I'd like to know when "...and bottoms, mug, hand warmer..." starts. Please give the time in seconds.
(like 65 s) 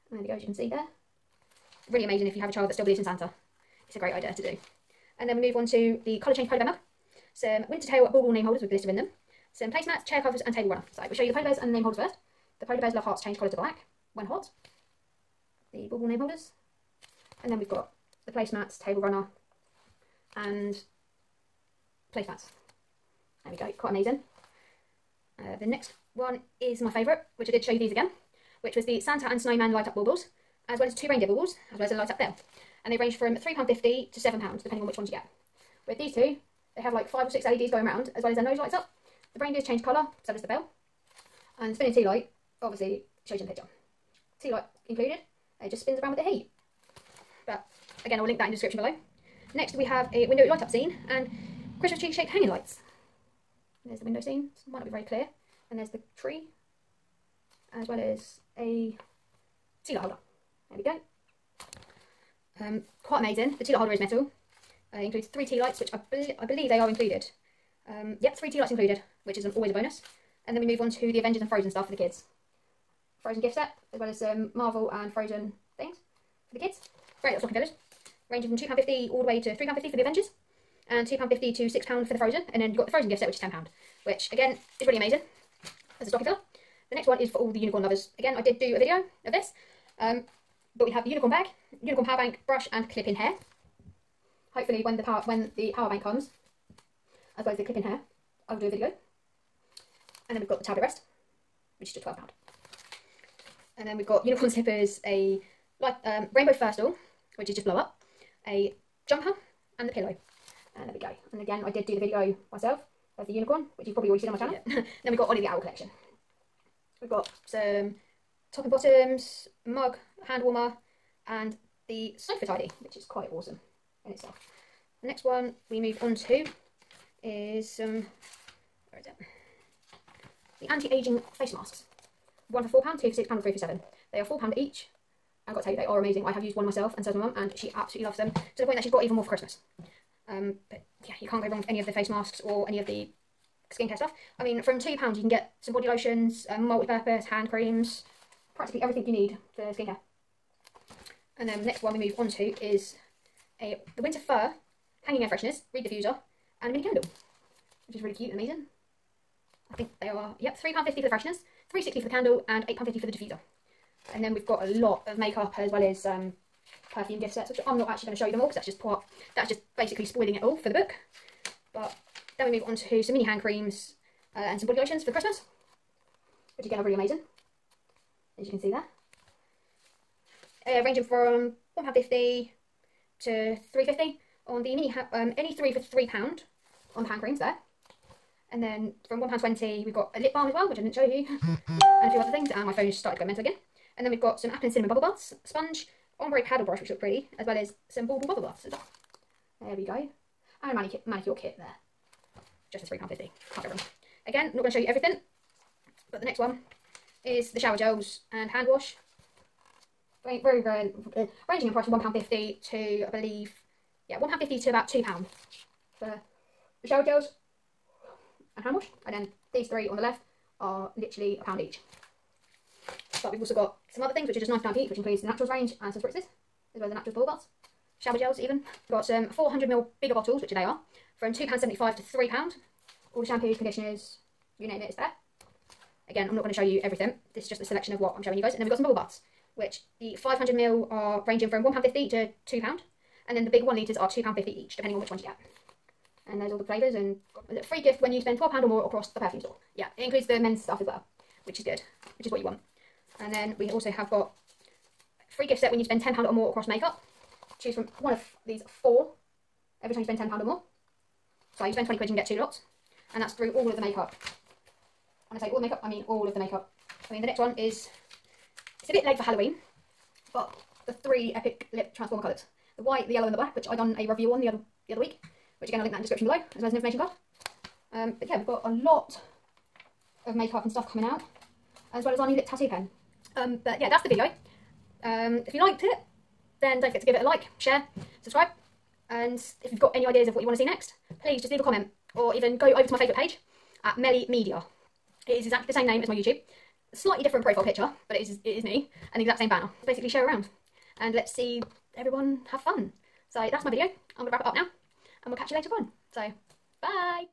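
118 s.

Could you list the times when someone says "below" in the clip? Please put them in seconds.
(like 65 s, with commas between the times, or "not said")
48 s, 276 s.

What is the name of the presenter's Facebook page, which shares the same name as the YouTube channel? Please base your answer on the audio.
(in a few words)
Melly Media.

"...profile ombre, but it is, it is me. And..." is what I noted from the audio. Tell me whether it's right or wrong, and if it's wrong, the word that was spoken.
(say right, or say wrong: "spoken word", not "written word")
wrong: "picture", not "ombre".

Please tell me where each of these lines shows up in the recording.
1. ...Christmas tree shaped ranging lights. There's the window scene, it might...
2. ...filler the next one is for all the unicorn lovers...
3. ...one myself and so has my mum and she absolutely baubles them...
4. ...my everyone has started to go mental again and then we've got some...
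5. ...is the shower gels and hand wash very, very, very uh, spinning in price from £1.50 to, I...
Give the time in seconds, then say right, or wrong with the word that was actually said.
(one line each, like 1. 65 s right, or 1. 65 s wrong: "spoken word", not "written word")
1. 51 s wrong: "hanging", not "ranging"
2. 86 s right
3. 136 s wrong: "loves", not "baubles"
4. 192 s wrong: "phone", not "everyone"
5. 207 s wrong: "ranging", not "spinning".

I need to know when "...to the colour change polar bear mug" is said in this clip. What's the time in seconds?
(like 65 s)
5 s.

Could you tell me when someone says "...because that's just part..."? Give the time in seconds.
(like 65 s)
168 s.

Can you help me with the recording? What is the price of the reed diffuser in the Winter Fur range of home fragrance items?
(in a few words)
£8.50.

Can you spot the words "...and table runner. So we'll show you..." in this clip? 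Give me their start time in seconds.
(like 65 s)
10 s.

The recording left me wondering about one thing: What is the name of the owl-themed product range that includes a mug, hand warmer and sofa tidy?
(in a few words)
Ollie the Owl.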